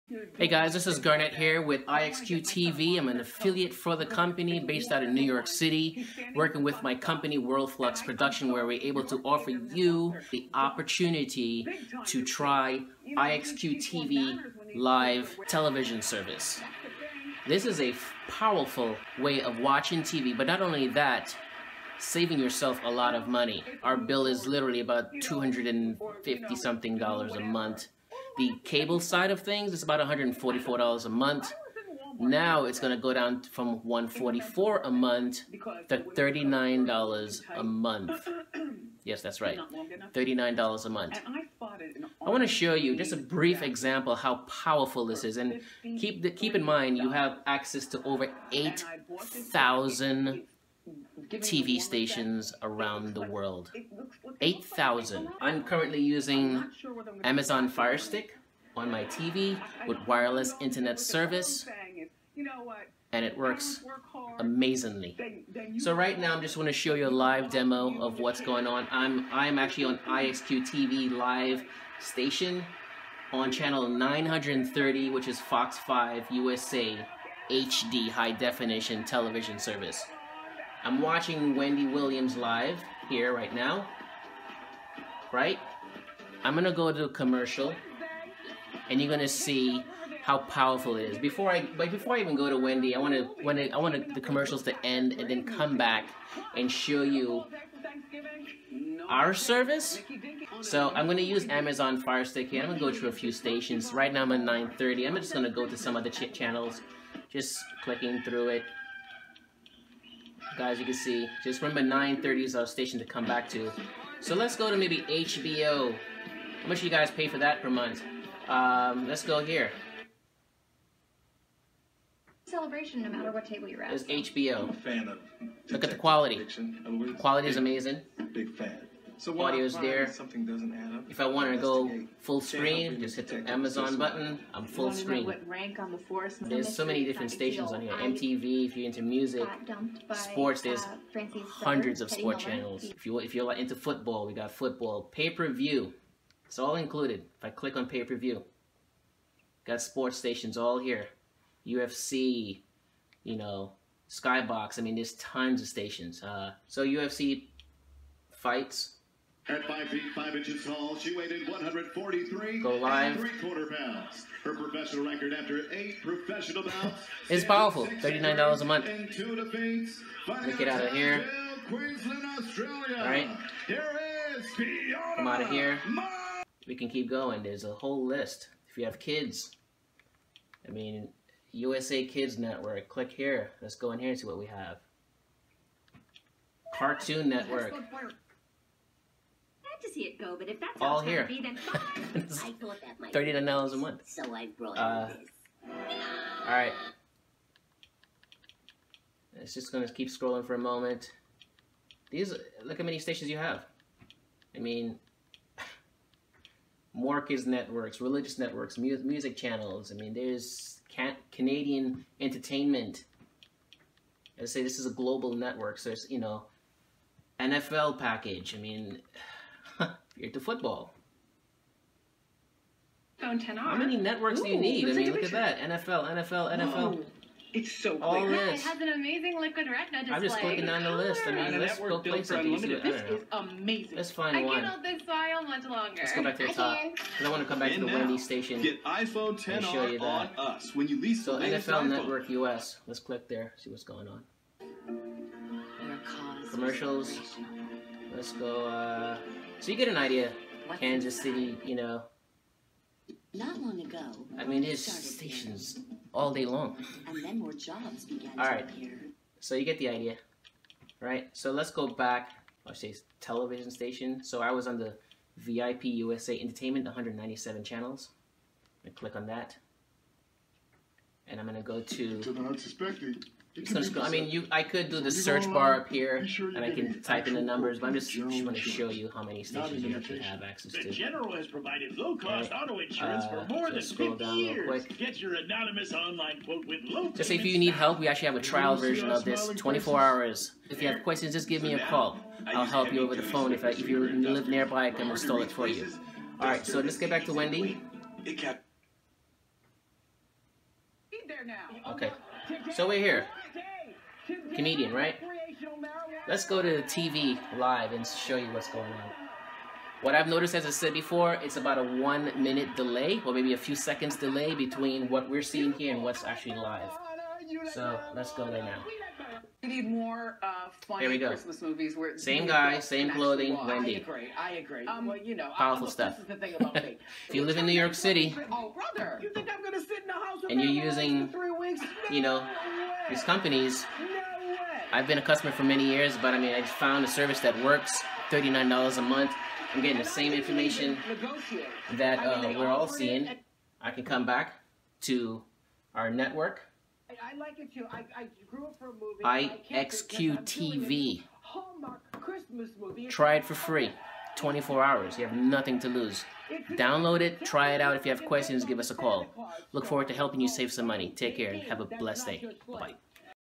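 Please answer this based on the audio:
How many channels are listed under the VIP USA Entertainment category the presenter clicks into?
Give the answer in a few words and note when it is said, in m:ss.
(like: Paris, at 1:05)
197, at 4:26.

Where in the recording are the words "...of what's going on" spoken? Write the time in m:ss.
1:07.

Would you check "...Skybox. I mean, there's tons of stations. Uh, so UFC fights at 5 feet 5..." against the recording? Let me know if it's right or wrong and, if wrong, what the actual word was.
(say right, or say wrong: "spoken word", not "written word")
right.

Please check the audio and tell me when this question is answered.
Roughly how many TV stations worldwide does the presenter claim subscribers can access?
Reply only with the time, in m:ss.
0:48.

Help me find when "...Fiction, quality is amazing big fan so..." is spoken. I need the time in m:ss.
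2:06.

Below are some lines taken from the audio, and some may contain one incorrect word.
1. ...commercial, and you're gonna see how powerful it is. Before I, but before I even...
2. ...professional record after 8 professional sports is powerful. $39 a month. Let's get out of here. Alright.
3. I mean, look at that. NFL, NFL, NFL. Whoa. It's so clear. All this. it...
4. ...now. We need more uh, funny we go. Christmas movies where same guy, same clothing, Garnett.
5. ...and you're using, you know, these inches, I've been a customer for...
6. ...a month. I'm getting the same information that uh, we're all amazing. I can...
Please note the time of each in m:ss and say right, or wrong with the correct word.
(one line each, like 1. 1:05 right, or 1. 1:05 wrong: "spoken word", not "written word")
1. 1:27 right
2. 2:44 wrong: "bouts", not "sports"
3. 3:44 right
4. 5:18 wrong: "Wendy", not "Garnett"
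5. 5:30 wrong: "companies", not "inches"
6. 5:38 wrong: "seeing", not "amazing".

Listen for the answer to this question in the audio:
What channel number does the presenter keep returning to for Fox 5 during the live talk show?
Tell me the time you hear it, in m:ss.
1:13.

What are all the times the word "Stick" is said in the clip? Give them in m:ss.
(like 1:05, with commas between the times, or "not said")
0:57, 1:42.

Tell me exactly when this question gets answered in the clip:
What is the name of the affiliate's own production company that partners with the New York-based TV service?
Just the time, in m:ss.
0:07.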